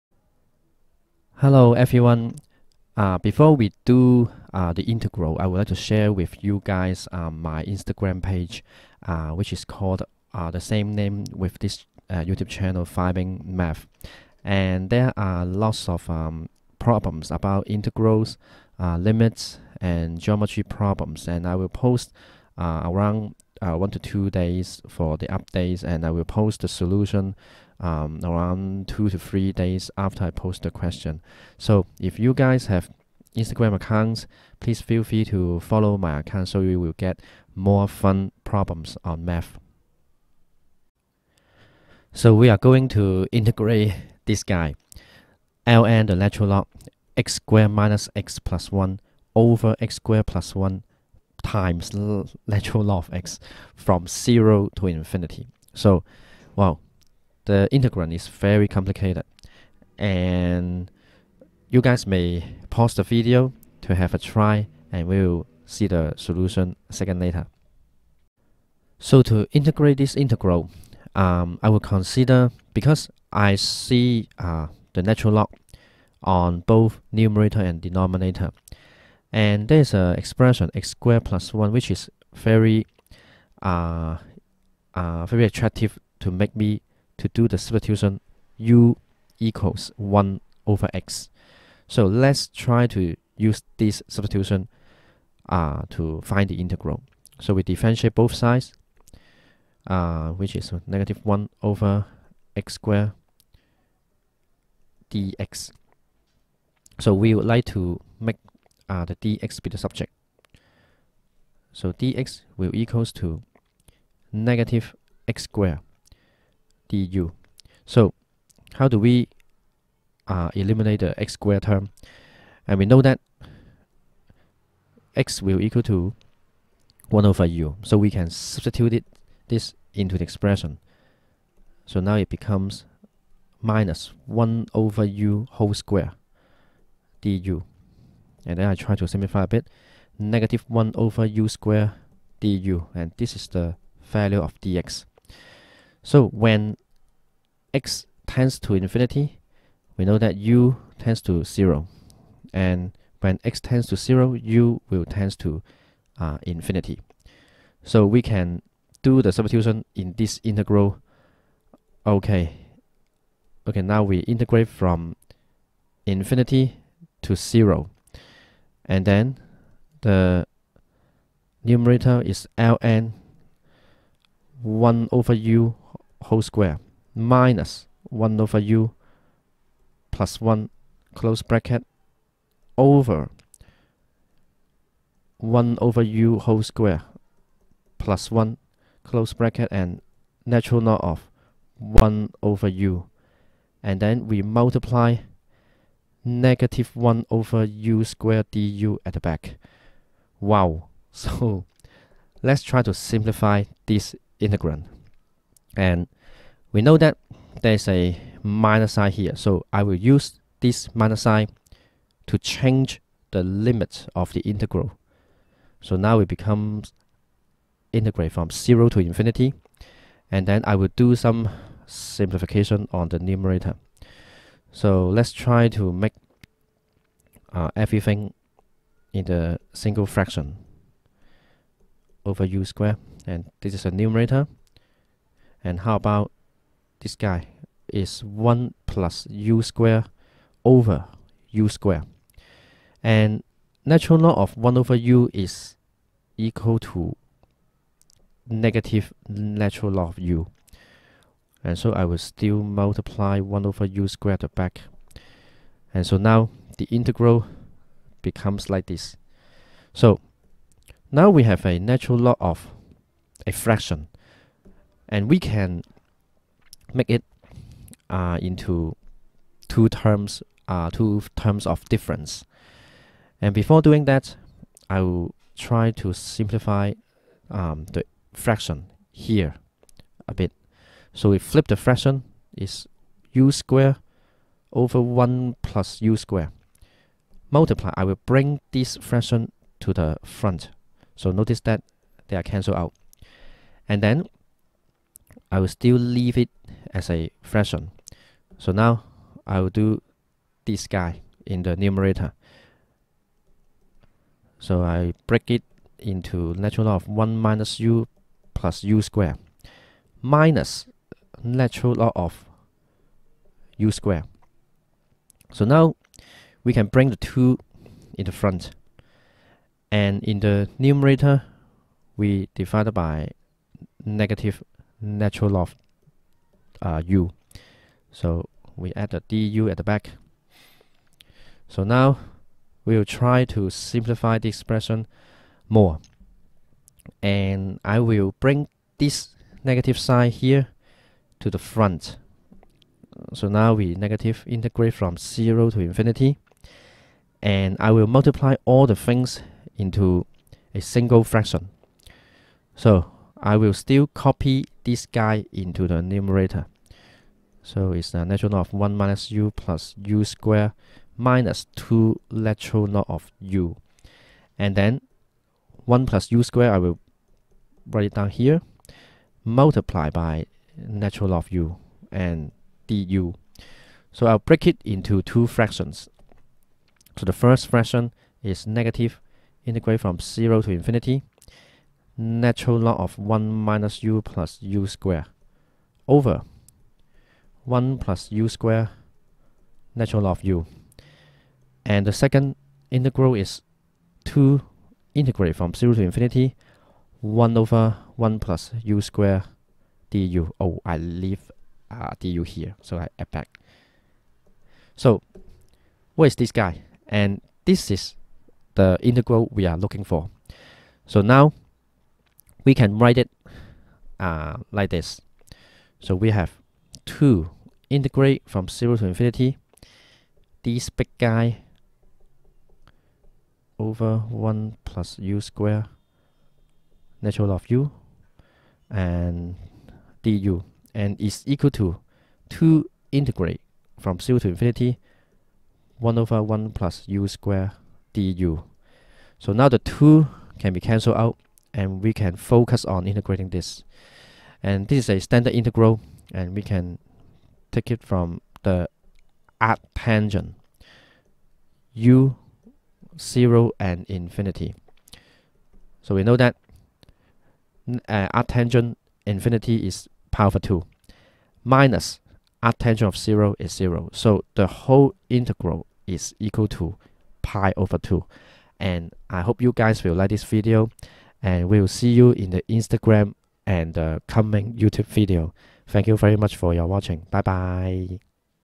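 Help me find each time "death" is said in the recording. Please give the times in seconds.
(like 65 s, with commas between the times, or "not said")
not said.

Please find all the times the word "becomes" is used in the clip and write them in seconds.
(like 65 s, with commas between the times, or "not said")
132 s, 216 s, 258 s.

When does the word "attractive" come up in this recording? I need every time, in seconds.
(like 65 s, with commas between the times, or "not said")
85 s.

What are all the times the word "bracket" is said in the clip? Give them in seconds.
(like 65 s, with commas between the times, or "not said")
181 s, 189 s.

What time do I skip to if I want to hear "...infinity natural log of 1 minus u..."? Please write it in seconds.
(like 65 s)
380 s.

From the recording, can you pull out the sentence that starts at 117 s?
So how do we uh, eliminate the x squared term?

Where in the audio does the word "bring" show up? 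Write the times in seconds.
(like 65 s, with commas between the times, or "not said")
288 s, 316 s, 338 s.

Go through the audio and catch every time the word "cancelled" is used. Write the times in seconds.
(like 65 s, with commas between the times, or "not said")
292 s, 440 s.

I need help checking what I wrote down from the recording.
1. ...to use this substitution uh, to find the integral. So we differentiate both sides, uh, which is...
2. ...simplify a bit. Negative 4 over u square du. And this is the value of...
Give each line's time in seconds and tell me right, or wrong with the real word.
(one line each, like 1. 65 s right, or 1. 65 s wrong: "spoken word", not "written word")
1. 92 s right
2. 139 s wrong: "1", not "4".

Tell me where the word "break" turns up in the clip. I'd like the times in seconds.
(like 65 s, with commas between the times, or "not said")
305 s, 374 s.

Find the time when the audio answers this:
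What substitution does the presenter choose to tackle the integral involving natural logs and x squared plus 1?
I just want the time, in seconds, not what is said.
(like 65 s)
88 s.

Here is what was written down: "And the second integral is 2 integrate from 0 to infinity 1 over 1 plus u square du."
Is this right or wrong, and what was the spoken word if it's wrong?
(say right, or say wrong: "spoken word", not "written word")
right.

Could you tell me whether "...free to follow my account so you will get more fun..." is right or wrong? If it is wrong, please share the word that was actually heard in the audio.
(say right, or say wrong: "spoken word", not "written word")
right.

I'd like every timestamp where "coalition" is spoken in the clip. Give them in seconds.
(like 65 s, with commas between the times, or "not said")
not said.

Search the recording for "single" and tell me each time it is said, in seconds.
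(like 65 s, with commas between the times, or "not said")
229 s, 350 s.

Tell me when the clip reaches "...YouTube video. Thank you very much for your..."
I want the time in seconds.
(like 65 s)
474 s.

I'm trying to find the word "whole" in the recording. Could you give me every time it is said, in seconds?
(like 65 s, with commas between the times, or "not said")
135 s, 176 s, 186 s, 464 s.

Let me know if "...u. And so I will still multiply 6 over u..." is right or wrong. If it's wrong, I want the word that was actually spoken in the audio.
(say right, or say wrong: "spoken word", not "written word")
wrong: "1", not "6".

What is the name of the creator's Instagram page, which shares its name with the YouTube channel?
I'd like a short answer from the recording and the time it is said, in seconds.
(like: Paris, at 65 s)
Vibing Math, at 12 s.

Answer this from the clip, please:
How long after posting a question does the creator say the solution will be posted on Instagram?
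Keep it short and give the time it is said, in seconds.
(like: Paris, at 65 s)
2 to 3 days, at 28 s.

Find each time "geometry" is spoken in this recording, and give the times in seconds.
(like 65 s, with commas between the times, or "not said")
20 s.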